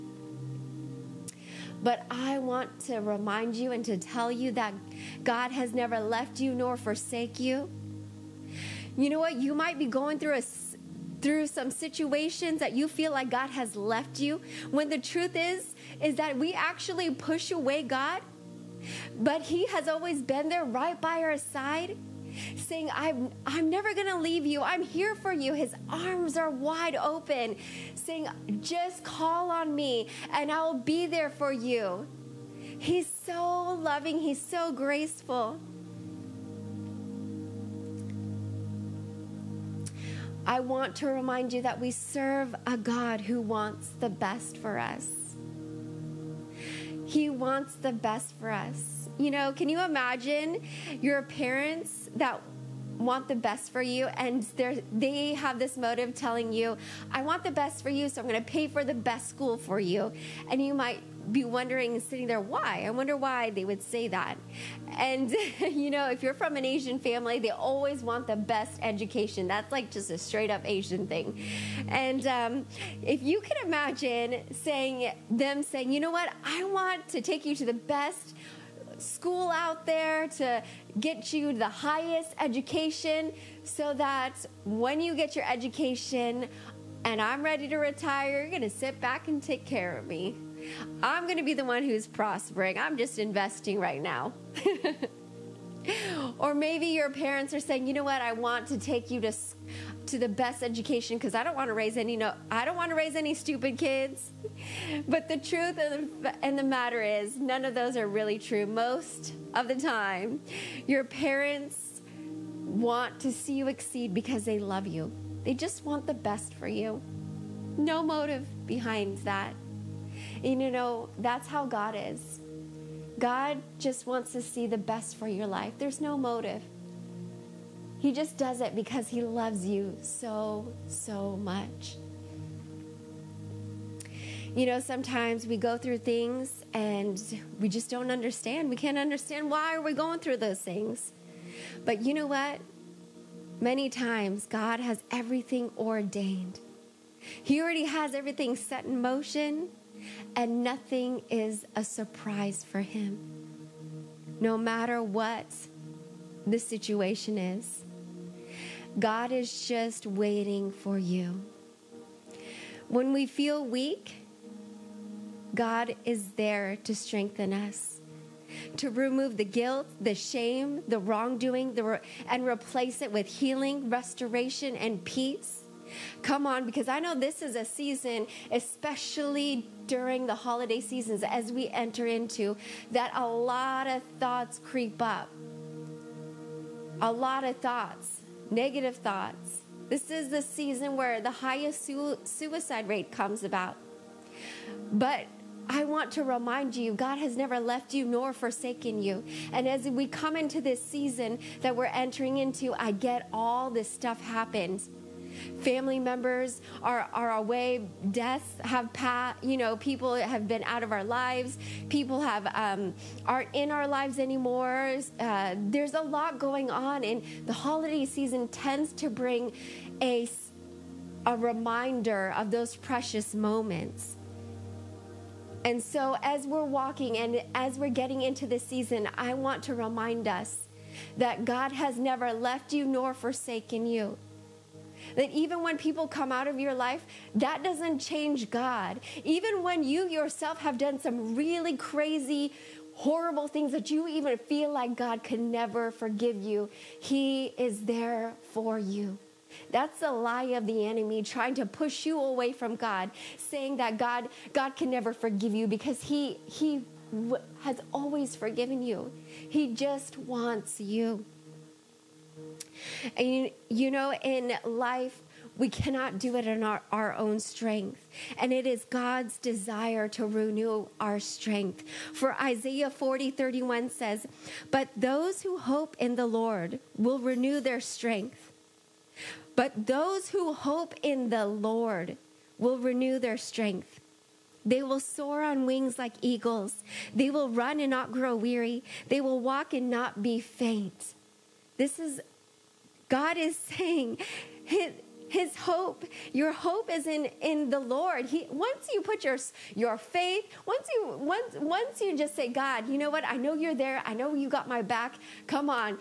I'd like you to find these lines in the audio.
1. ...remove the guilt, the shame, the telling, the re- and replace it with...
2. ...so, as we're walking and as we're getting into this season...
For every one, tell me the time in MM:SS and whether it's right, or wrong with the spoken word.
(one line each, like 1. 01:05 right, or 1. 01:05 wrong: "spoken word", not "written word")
1. 02:48 wrong: "wrongdoing", not "telling"
2. 03:45 right.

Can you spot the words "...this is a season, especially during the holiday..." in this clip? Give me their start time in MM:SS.
02:57.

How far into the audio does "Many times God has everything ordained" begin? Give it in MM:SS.
02:23.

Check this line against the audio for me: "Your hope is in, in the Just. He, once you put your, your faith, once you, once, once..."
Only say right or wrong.
wrong.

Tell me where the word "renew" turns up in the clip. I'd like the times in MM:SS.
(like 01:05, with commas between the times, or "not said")
04:30, 04:37, 04:42.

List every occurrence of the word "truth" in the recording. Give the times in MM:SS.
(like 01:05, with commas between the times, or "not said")
00:14, 01:45.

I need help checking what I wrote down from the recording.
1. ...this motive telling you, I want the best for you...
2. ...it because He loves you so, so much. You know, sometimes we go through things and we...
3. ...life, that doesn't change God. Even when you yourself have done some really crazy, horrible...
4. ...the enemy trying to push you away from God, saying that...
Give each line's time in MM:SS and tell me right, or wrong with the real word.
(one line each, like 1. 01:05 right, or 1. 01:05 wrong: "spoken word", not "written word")
1. 00:55 right
2. 02:08 right
3. 03:56 right
4. 04:10 right.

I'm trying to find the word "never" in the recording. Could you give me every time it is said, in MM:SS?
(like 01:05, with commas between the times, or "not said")
00:05, 00:23, 03:17, 03:51, 04:05, 04:14.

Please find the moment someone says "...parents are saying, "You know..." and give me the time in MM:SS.
01:37.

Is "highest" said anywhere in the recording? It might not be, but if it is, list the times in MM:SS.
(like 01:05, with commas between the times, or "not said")
01:21, 03:11.